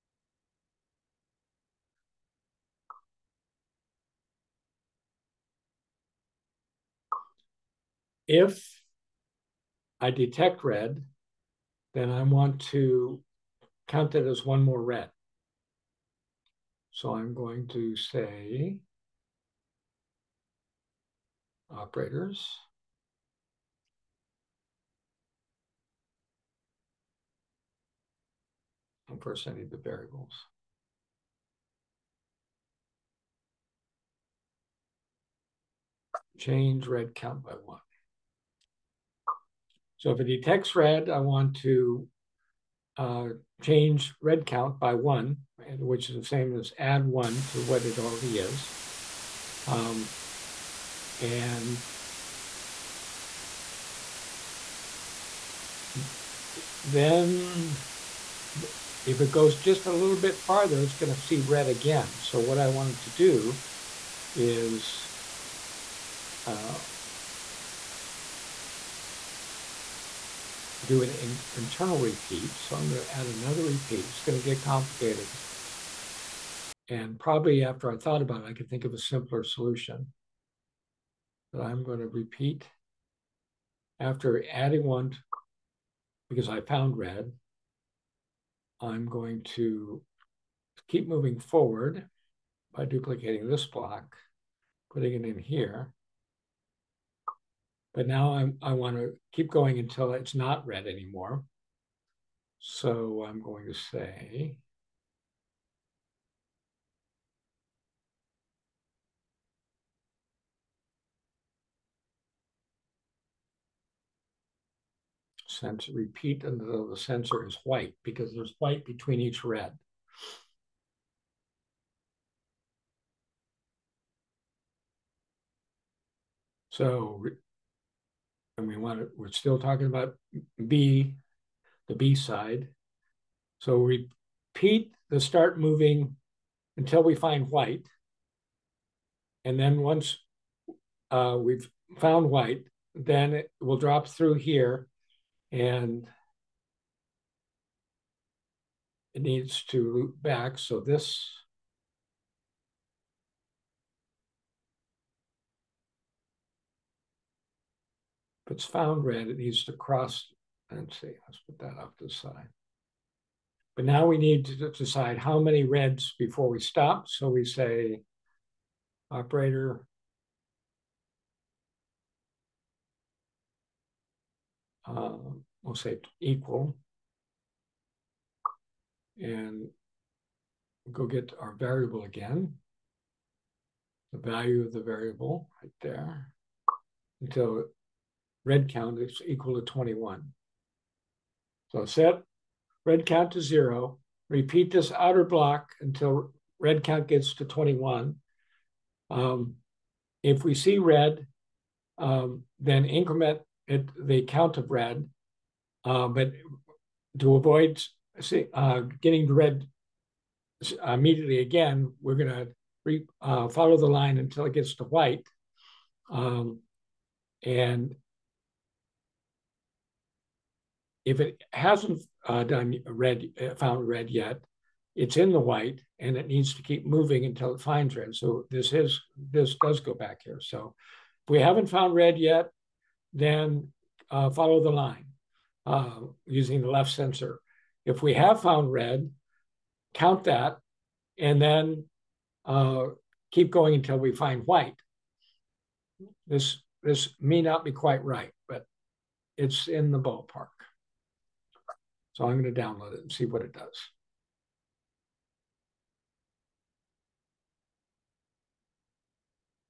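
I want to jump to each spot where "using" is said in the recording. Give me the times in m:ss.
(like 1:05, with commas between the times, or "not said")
3:56.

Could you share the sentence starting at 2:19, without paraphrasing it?
And then once uh, we've found white, then it will drop through here and it needs to loop back.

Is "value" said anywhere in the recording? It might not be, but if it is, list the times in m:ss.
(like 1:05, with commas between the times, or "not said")
3:04.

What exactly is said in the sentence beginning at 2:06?
So and we want to, we're still talking about B, the B side.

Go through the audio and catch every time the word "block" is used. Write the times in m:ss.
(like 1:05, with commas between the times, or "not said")
1:33, 3:15.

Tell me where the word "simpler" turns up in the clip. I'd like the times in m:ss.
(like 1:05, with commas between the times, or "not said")
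1:18.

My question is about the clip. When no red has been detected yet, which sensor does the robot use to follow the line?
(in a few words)
left sensor.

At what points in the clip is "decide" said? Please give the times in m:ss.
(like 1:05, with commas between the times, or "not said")
2:44.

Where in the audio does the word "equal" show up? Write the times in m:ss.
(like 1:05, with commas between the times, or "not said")
2:56, 3:09.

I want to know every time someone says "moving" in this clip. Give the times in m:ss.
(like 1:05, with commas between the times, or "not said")
1:31, 2:15, 3:46.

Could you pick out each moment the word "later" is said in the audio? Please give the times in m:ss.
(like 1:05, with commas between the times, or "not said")
not said.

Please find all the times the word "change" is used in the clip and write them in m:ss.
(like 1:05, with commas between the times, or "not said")
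0:36, 0:43.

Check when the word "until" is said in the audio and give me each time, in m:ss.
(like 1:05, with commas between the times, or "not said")
1:39, 1:56, 2:16, 3:07, 3:15, 3:34, 3:47, 4:03.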